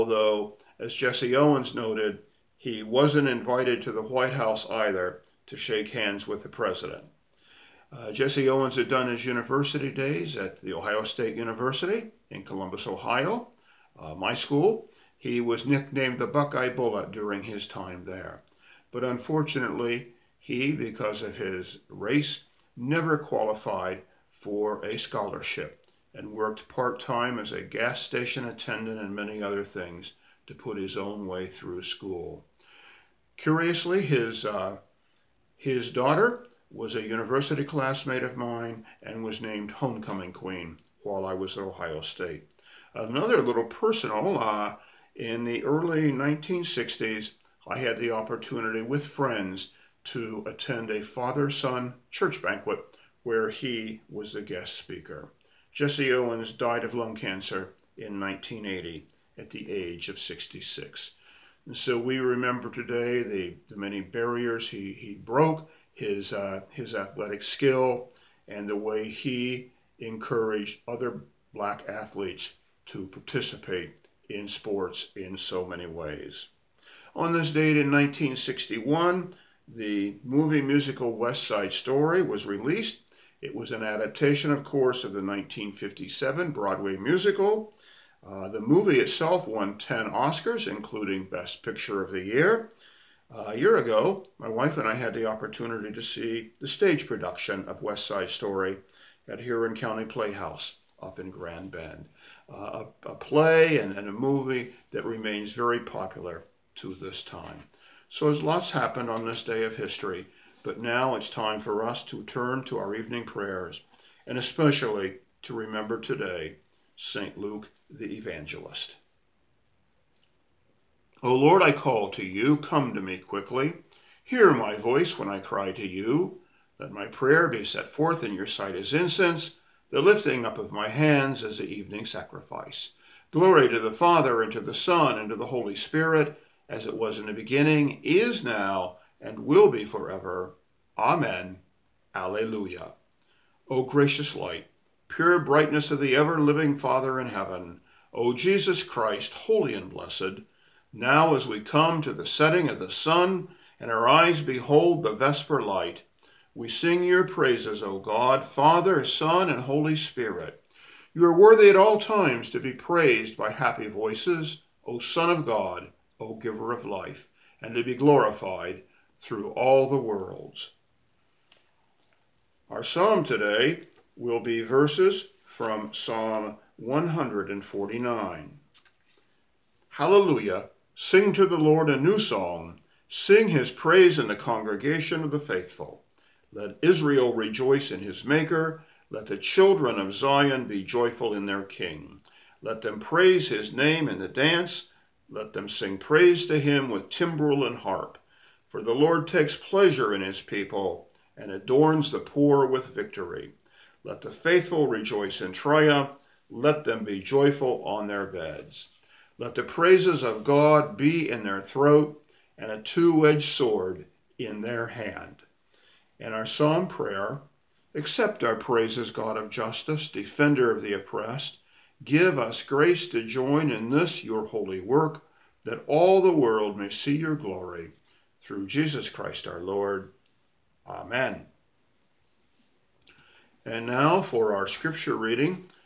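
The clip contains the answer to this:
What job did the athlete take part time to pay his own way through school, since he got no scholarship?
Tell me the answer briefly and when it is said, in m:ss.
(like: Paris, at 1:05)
gas station attendant, at 0:27.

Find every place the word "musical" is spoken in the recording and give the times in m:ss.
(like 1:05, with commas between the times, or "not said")
1:20, 1:26.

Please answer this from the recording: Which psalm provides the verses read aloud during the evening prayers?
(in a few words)
Psalm 149.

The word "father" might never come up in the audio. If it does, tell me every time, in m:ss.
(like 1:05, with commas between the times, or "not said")
0:51, 2:13, 2:26, 2:38.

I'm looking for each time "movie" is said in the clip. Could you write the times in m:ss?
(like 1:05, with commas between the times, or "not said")
1:20, 1:28, 1:44.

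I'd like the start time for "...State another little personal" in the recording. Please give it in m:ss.
0:41.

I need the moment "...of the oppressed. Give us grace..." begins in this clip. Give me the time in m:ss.
3:40.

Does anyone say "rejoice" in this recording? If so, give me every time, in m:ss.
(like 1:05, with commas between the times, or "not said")
3:07, 3:24.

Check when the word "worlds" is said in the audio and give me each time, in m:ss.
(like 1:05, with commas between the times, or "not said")
2:49, 3:46.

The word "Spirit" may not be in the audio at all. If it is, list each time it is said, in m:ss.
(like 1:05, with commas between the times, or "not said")
2:15, 2:39.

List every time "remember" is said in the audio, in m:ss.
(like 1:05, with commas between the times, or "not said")
1:02, 1:55.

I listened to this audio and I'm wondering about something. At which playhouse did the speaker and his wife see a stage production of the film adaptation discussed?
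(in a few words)
Huron County Playhouse.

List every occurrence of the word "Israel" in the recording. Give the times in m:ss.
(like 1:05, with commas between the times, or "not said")
3:06.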